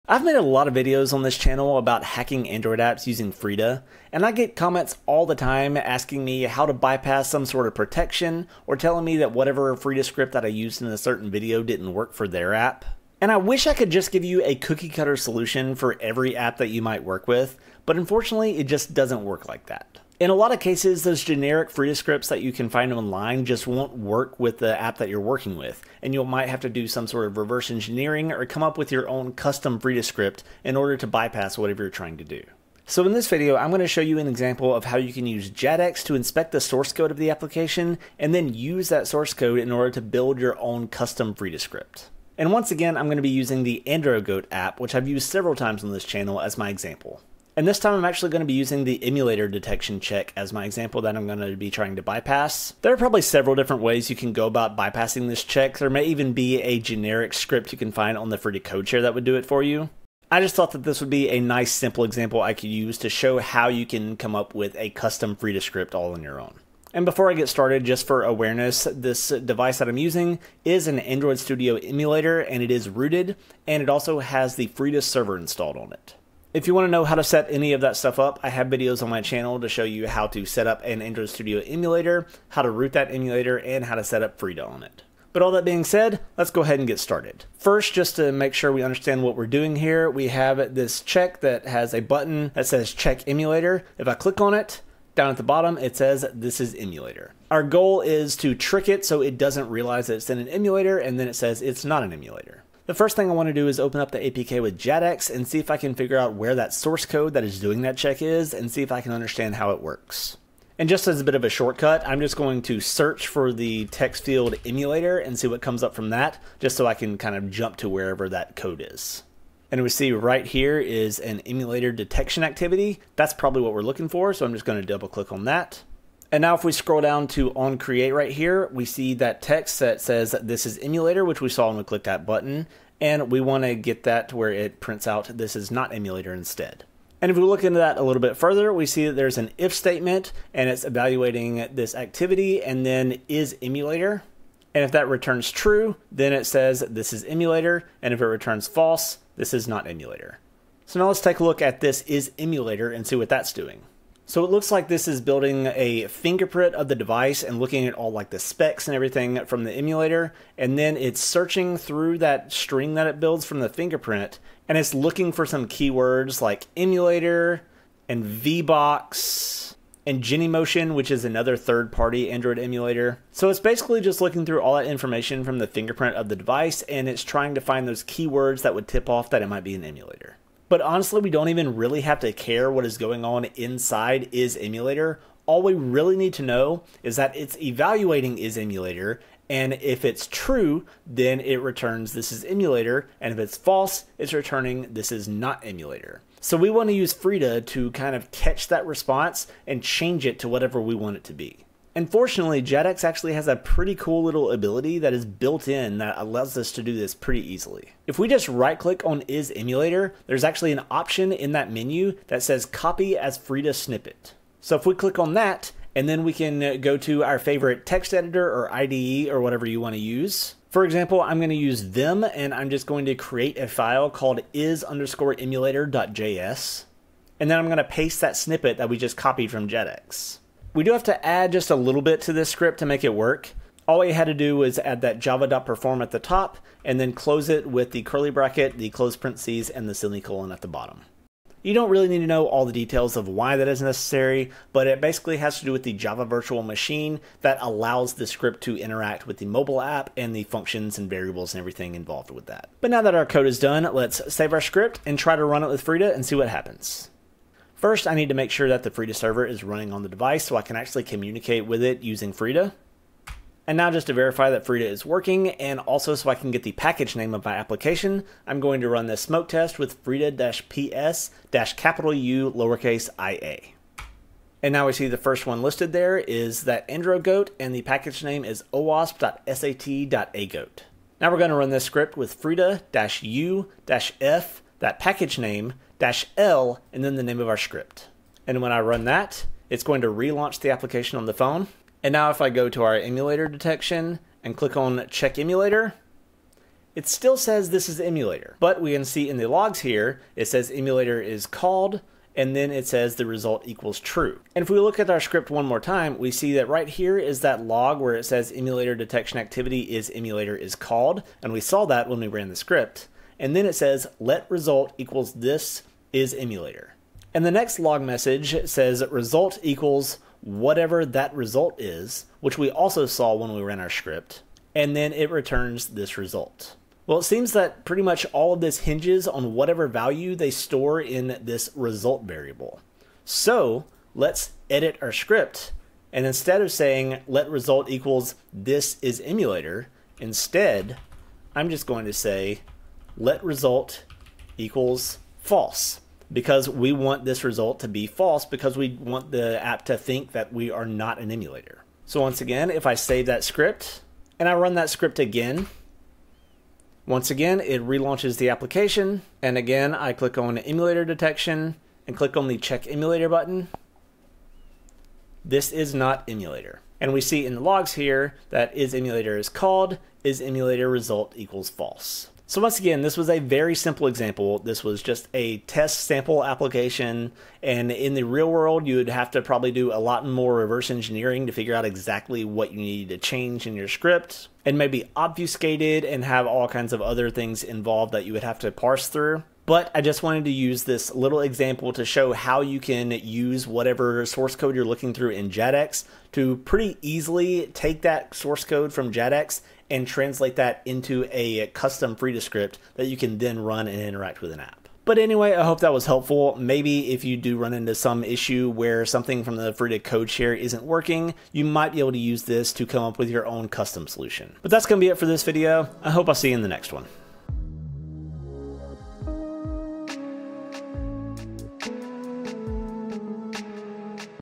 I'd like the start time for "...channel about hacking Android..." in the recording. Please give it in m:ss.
0:01.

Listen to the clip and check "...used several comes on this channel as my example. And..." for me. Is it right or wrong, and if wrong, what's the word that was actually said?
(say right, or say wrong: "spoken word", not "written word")
wrong: "times", not "comes".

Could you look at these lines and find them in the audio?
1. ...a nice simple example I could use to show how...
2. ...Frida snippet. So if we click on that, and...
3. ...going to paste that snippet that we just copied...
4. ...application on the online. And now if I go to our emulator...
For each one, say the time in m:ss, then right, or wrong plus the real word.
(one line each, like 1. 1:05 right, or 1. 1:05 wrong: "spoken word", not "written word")
1. 1:01 right
2. 3:33 right
3. 3:47 right
4. 4:50 wrong: "phone", not "online".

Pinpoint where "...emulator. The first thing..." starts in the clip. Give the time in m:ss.
1:42.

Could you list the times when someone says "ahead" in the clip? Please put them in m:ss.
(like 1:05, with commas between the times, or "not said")
1:26.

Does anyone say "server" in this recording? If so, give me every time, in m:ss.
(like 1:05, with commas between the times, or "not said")
1:15, 4:19.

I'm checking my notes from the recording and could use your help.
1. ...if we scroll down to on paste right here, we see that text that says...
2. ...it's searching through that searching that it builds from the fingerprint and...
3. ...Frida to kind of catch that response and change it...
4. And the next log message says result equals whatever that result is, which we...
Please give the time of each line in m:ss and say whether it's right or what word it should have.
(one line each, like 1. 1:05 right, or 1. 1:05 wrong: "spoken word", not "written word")
1. 2:06 wrong: "create", not "paste"
2. 2:40 wrong: "string", not "searching"
3. 3:17 right
4. 5:17 right.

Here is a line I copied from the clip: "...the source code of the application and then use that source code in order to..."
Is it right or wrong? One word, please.
right.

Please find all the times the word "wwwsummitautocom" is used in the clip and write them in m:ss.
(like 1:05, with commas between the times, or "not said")
not said.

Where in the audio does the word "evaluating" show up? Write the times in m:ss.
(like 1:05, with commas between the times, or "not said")
2:20, 3:07.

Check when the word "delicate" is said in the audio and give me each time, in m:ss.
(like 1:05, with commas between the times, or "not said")
not said.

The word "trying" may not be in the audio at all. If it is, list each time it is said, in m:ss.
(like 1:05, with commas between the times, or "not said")
0:31, 0:51, 2:57.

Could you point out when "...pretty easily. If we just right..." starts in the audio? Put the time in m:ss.
3:27.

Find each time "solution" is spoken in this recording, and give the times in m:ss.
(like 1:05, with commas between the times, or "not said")
0:15, 6:54.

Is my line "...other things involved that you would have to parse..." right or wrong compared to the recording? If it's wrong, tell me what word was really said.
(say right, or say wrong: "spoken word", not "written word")
right.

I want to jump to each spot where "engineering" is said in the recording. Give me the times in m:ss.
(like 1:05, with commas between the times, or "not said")
0:27, 6:20.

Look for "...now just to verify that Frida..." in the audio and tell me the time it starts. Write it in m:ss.
4:23.